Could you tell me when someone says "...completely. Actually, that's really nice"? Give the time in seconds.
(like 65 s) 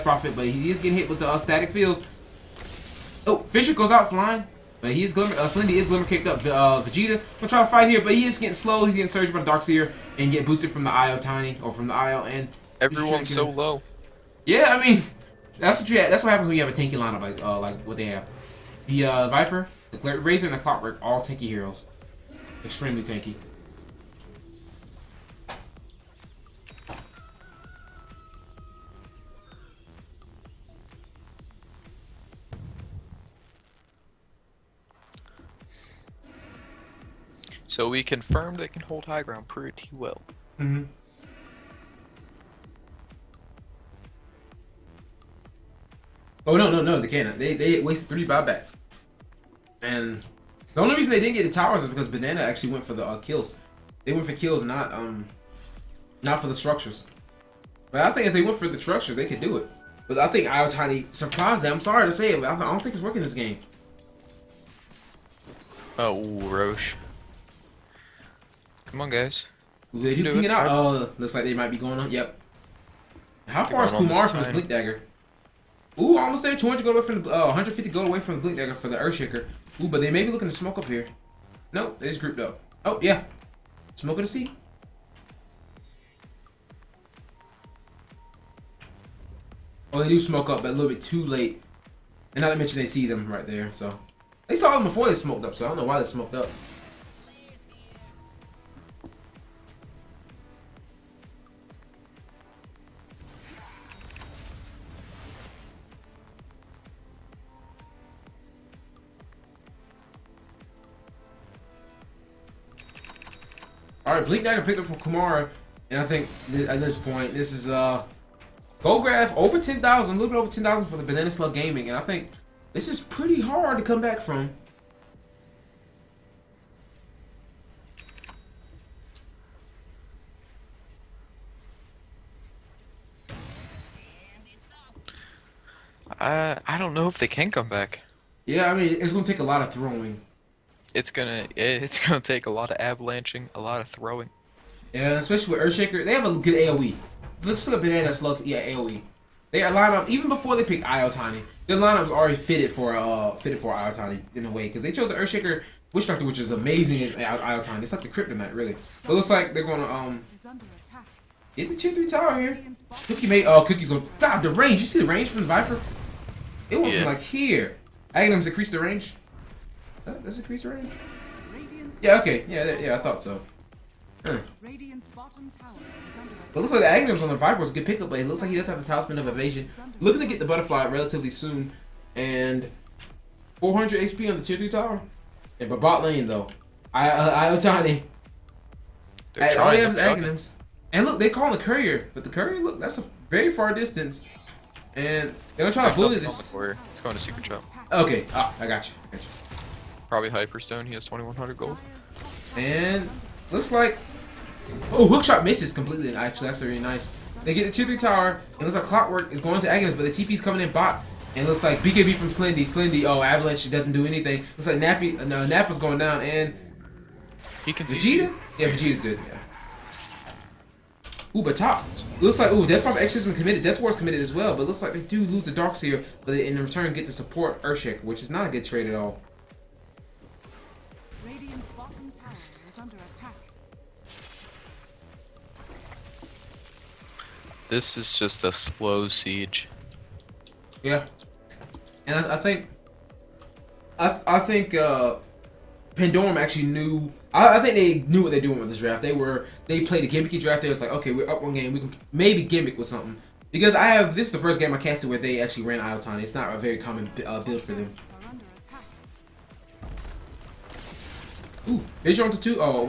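205 s.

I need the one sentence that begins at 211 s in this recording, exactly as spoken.
And it looks like BKB from Slendy.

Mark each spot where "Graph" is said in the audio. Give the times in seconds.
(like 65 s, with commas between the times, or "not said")
119 s.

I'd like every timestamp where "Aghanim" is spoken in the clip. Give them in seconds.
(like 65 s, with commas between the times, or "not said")
168 s, 176 s, 189 s.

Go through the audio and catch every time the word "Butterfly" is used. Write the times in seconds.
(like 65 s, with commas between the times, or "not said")
180 s.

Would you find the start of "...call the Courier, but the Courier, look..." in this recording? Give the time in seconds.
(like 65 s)
191 s.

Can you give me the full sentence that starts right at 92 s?
And not to mention they see them right there, so.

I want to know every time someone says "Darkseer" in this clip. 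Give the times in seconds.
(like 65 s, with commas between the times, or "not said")
9 s, 225 s.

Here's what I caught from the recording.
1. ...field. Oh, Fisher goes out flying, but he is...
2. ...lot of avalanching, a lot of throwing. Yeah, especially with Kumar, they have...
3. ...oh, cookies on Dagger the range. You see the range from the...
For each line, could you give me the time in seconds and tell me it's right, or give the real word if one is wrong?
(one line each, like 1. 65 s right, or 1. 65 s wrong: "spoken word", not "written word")
1. 1 s right
2. 142 s wrong: "Earthshaker", not "Kumar"
3. 163 s wrong: "God", not "Dagger".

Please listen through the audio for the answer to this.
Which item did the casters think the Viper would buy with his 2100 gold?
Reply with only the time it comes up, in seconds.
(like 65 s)
200 s.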